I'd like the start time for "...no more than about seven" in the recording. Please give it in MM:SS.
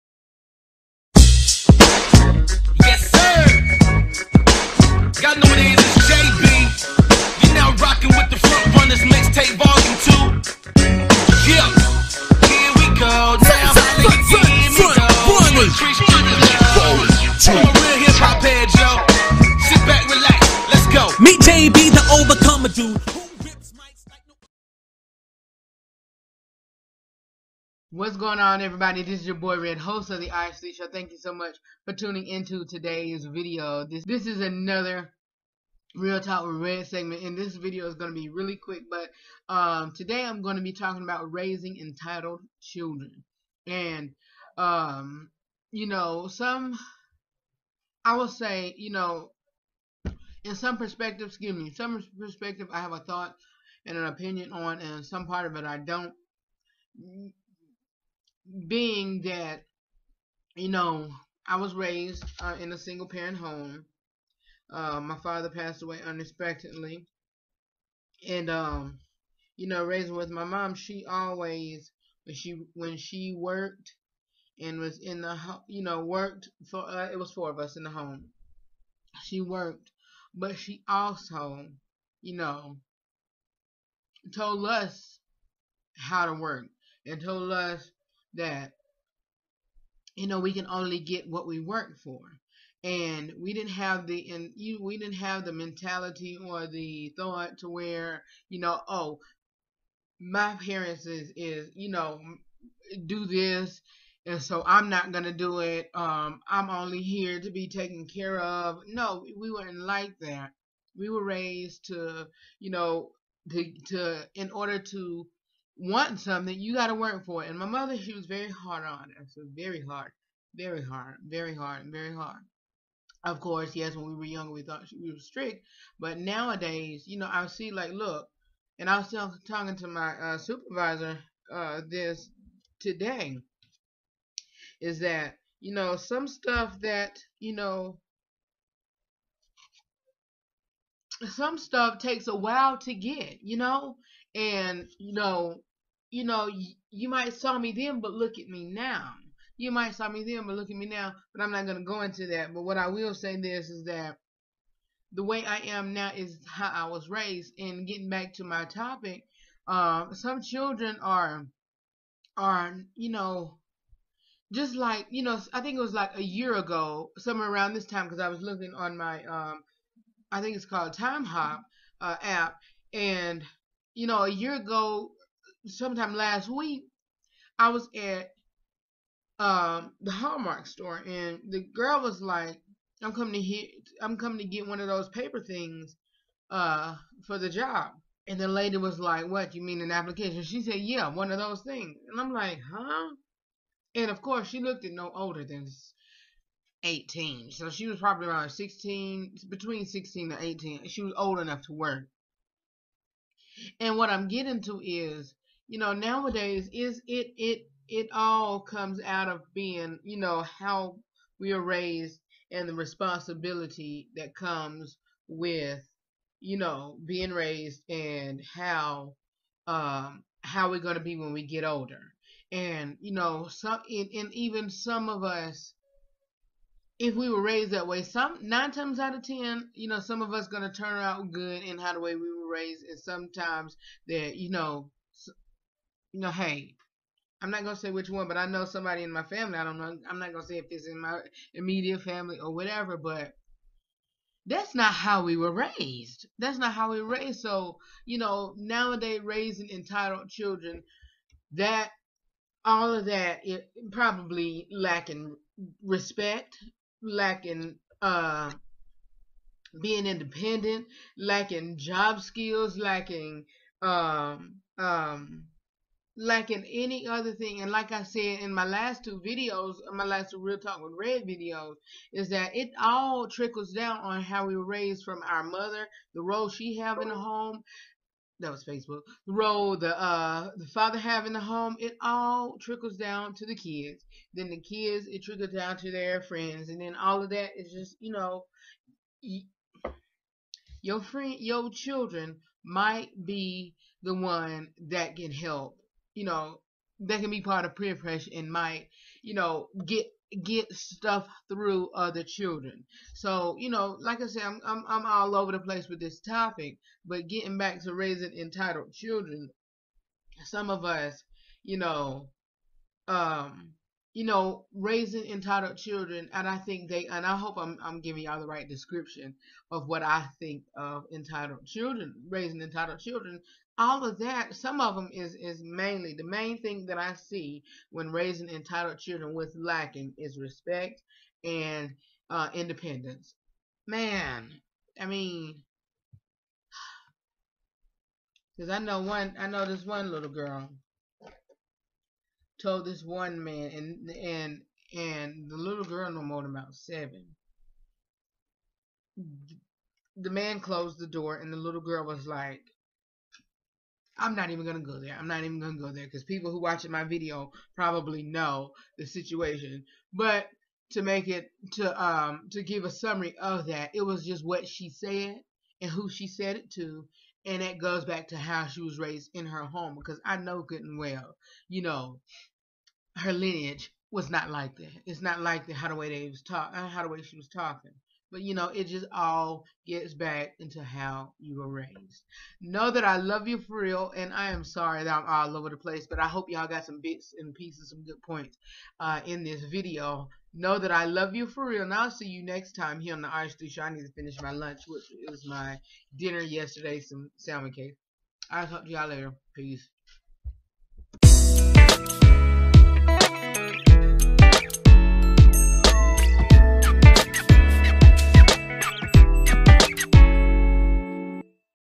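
05:46.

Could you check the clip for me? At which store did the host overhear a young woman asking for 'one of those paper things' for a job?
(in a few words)
Hallmark.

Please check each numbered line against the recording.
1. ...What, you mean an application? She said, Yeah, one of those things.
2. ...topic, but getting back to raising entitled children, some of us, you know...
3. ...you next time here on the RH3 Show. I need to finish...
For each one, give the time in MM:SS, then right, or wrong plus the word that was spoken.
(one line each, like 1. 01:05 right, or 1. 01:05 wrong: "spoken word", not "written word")
1. 03:09 right
2. 05:06 right
3. 06:32 right.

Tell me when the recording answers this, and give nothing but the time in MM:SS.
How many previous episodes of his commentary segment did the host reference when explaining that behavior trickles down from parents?
04:29.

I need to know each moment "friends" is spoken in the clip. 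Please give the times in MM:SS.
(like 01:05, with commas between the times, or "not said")
04:46, 04:51.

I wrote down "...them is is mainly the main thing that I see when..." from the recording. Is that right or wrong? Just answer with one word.
right.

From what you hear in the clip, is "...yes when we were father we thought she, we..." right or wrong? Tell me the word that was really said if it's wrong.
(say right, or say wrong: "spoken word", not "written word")
wrong: "younger", not "father".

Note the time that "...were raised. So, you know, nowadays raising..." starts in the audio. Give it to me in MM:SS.
04:07.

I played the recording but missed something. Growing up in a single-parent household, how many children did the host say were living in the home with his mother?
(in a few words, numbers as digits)
4.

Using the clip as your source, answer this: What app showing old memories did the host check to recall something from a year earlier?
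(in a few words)
Timehop.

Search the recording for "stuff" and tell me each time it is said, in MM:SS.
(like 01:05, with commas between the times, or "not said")
02:16, 02:21, 05:00.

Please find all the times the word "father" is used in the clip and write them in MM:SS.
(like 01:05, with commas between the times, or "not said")
01:05, 04:40.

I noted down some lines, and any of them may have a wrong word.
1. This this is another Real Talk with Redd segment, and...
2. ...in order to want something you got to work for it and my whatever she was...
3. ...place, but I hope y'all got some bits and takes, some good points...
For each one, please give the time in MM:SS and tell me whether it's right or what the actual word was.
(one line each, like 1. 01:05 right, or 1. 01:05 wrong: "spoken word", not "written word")
1. 00:33 right
2. 01:54 wrong: "mother", not "whatever"
3. 06:25 wrong: "pieces", not "takes".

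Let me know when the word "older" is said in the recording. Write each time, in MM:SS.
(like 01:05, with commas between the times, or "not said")
03:15, 03:41.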